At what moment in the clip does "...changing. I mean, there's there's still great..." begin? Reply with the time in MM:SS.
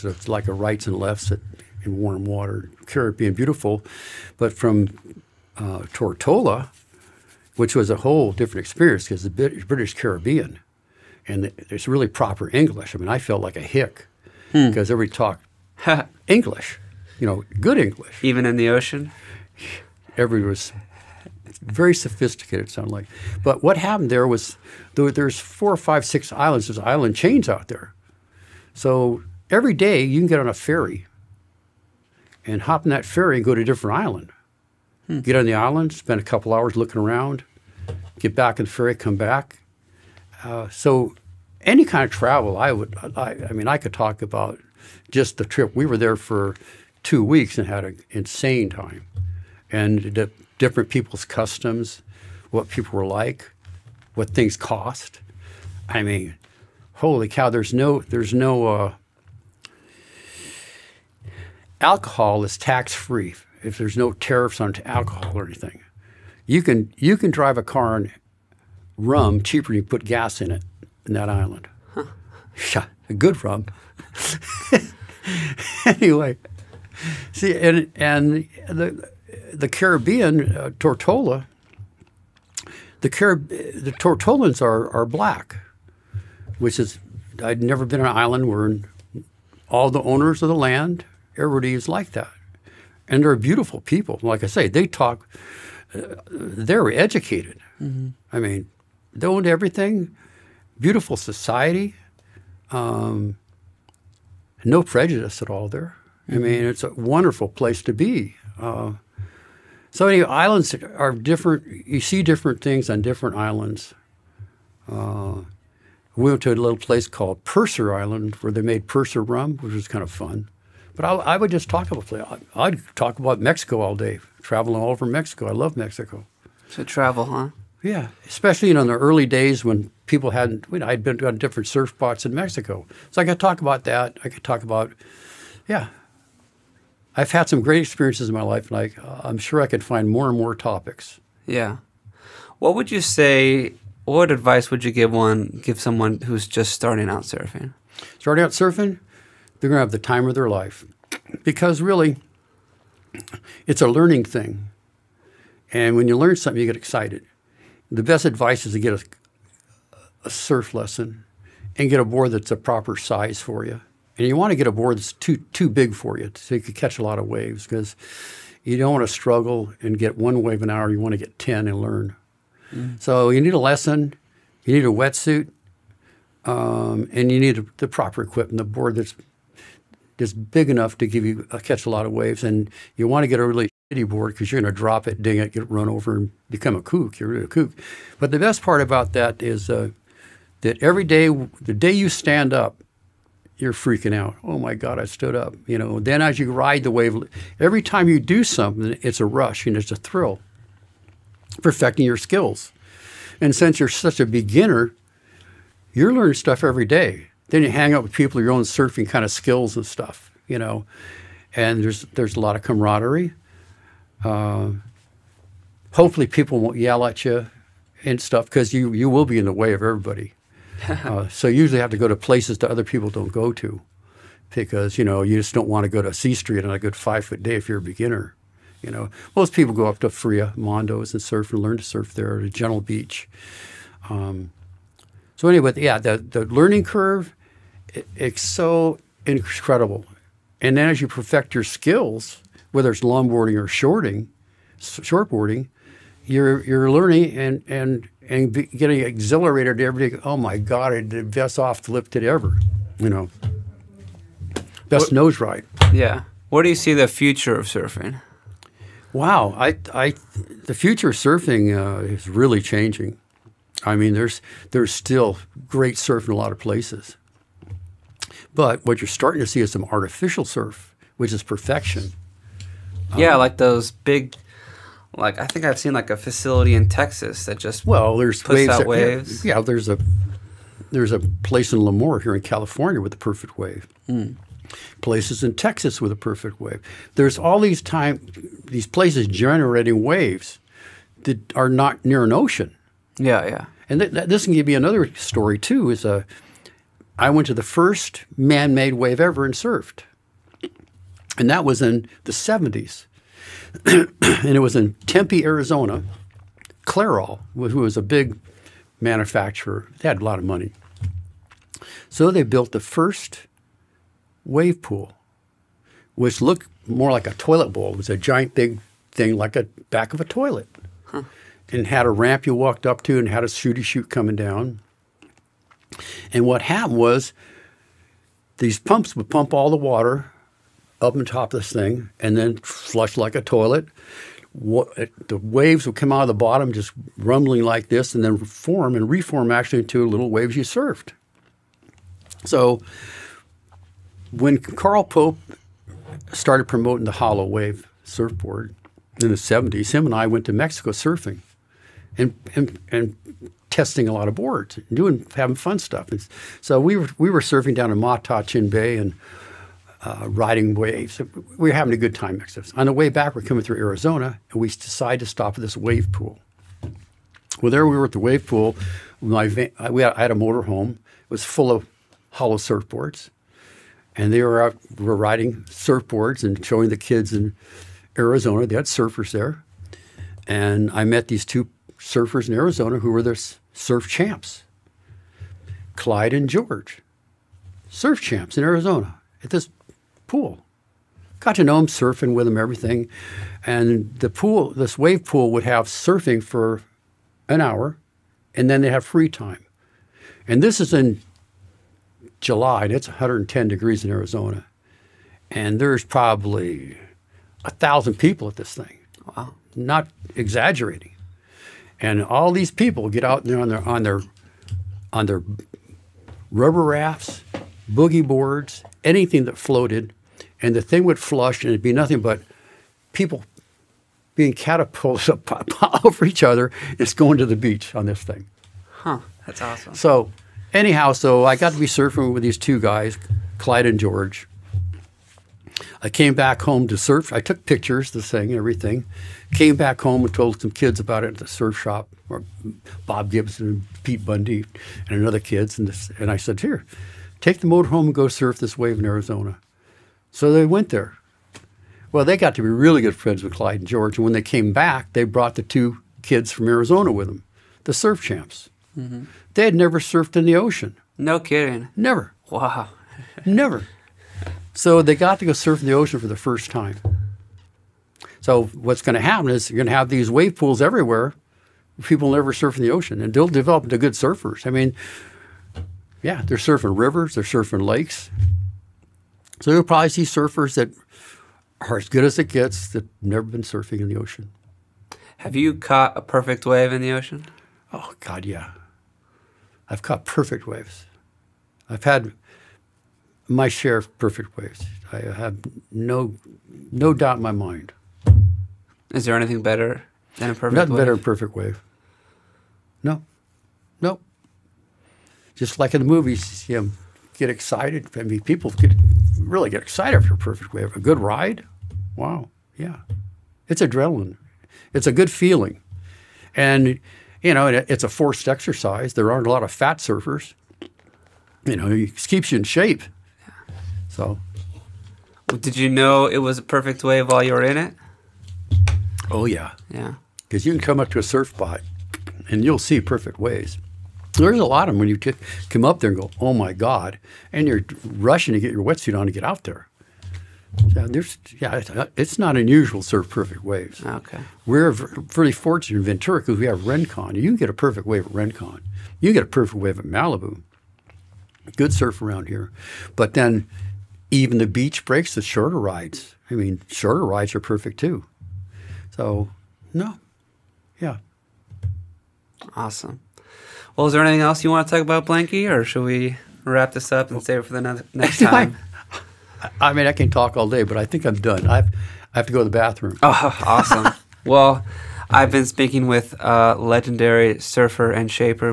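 04:22.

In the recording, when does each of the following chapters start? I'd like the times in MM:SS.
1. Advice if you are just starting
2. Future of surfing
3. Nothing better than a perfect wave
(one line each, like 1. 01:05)
1. 02:19
2. 04:13
3. 08:02.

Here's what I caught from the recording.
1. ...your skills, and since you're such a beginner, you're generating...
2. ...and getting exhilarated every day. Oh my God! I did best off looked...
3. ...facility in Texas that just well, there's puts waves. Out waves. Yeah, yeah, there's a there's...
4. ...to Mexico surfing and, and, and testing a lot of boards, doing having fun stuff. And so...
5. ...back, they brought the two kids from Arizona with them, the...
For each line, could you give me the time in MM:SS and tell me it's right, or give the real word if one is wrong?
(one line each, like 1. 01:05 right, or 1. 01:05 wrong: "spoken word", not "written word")
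1. 03:22 wrong: "learning", not "generating"
2. 04:08 wrong: "lifted", not "looked"
3. 04:36 right
4. 05:50 right
5. 07:34 right.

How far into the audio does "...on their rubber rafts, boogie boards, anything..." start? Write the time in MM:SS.
06:55.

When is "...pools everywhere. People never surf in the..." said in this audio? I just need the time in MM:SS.
07:50.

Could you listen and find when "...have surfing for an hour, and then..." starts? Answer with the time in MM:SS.
06:35.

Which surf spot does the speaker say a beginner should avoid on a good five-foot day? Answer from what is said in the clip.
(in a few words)
C Street.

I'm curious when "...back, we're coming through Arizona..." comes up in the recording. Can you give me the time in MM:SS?
06:03.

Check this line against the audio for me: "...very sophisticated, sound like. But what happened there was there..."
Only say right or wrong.
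right.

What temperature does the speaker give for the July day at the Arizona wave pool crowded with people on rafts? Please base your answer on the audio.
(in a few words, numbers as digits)
110 degrees.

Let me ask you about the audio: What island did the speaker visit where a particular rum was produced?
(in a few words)
Pusser Island.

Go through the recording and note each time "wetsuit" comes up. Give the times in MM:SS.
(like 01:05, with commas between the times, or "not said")
02:54, 08:58.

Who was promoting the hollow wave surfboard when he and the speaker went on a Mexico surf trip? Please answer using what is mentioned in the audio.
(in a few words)
Carl Pope.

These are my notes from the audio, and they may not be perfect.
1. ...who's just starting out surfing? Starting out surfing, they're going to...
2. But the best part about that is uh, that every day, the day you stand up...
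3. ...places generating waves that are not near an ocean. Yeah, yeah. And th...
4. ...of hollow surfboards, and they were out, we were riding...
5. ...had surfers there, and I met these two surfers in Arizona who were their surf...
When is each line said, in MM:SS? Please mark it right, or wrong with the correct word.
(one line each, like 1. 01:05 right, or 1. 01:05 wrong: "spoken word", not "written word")
1. 02:26 right
2. 03:08 right
3. 04:48 right
4. 06:11 right
5. 06:18 right.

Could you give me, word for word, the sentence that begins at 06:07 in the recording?
Well, there we were at the wave pool.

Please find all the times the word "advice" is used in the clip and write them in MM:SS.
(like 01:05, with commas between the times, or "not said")
02:24, 02:38.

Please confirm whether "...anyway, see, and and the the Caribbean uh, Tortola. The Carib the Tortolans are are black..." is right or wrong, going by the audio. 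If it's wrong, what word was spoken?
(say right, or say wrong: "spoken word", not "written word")
right.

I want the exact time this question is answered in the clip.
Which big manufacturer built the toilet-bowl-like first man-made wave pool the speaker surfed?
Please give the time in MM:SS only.
05:06.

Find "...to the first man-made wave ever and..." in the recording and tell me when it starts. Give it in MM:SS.
04:57.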